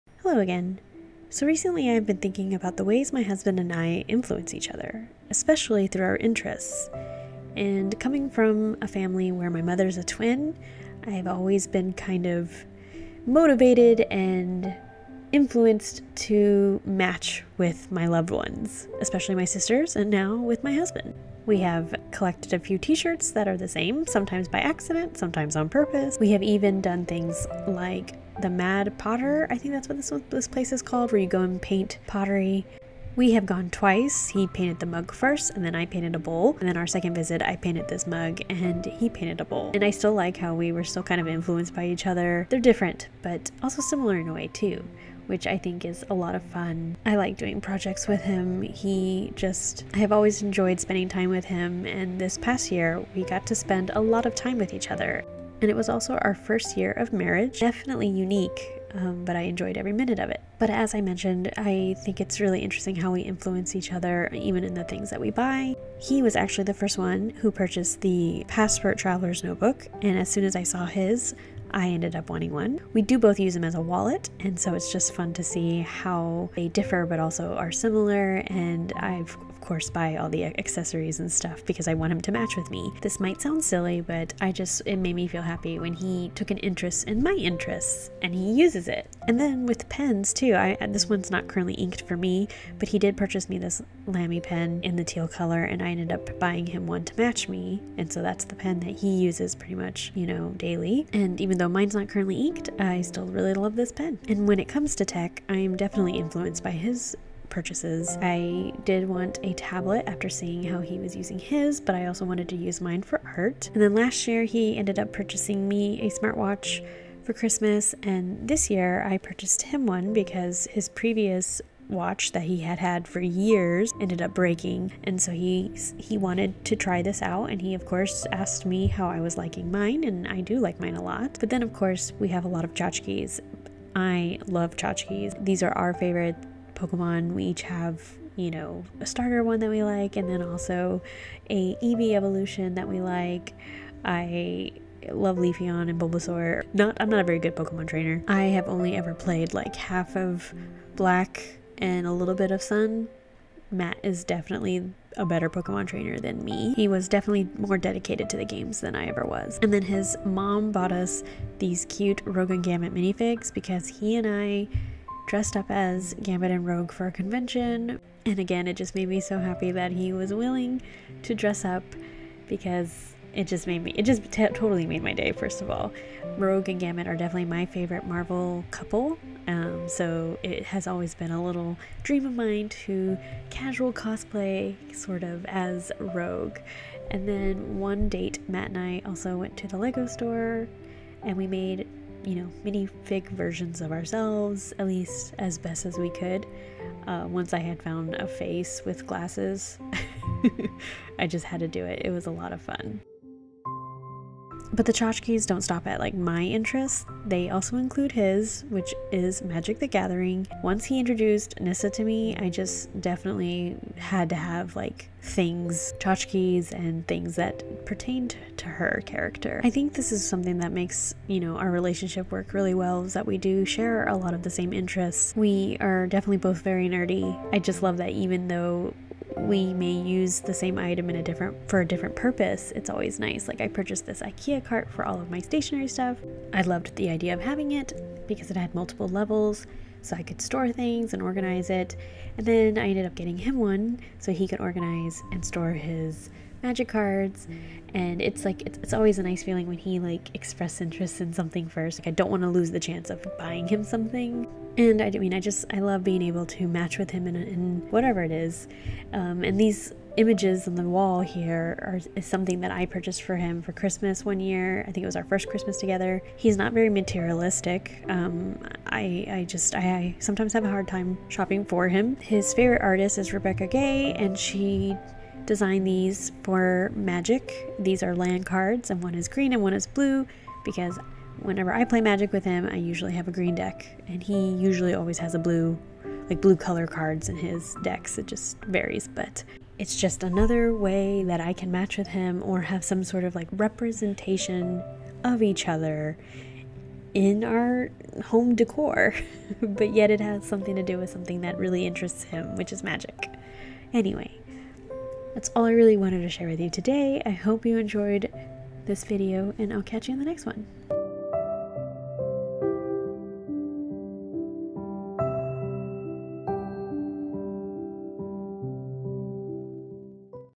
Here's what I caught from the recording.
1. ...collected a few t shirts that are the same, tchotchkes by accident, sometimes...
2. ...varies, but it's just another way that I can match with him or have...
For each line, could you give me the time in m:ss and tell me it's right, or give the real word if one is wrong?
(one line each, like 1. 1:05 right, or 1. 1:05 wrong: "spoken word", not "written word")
1. 0:22 wrong: "sometimes", not "tchotchkes"
2. 4:48 right.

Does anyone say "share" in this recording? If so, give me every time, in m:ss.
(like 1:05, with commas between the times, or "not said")
3:43, 5:06.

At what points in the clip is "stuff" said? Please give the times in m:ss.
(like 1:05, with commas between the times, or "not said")
1:21, 3:55.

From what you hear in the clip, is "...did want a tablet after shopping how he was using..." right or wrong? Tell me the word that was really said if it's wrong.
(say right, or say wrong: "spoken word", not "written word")
wrong: "seeing", not "shopping".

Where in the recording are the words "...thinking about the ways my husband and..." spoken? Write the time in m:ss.
0:02.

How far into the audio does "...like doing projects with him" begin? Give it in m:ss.
0:47.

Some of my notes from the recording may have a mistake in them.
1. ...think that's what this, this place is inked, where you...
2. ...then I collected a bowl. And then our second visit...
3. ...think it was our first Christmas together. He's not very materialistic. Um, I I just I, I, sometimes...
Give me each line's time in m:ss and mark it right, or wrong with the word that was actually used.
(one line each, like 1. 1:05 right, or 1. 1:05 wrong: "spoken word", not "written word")
1. 0:29 wrong: "called", not "inked"
2. 0:35 wrong: "painted", not "collected"
3. 4:24 right.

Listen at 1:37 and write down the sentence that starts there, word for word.
And so that's the pen that he uses pretty much, you know, daily.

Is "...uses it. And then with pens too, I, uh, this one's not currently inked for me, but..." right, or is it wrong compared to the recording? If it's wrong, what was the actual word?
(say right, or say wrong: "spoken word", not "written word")
right.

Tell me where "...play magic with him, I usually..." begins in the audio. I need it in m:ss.
4:41.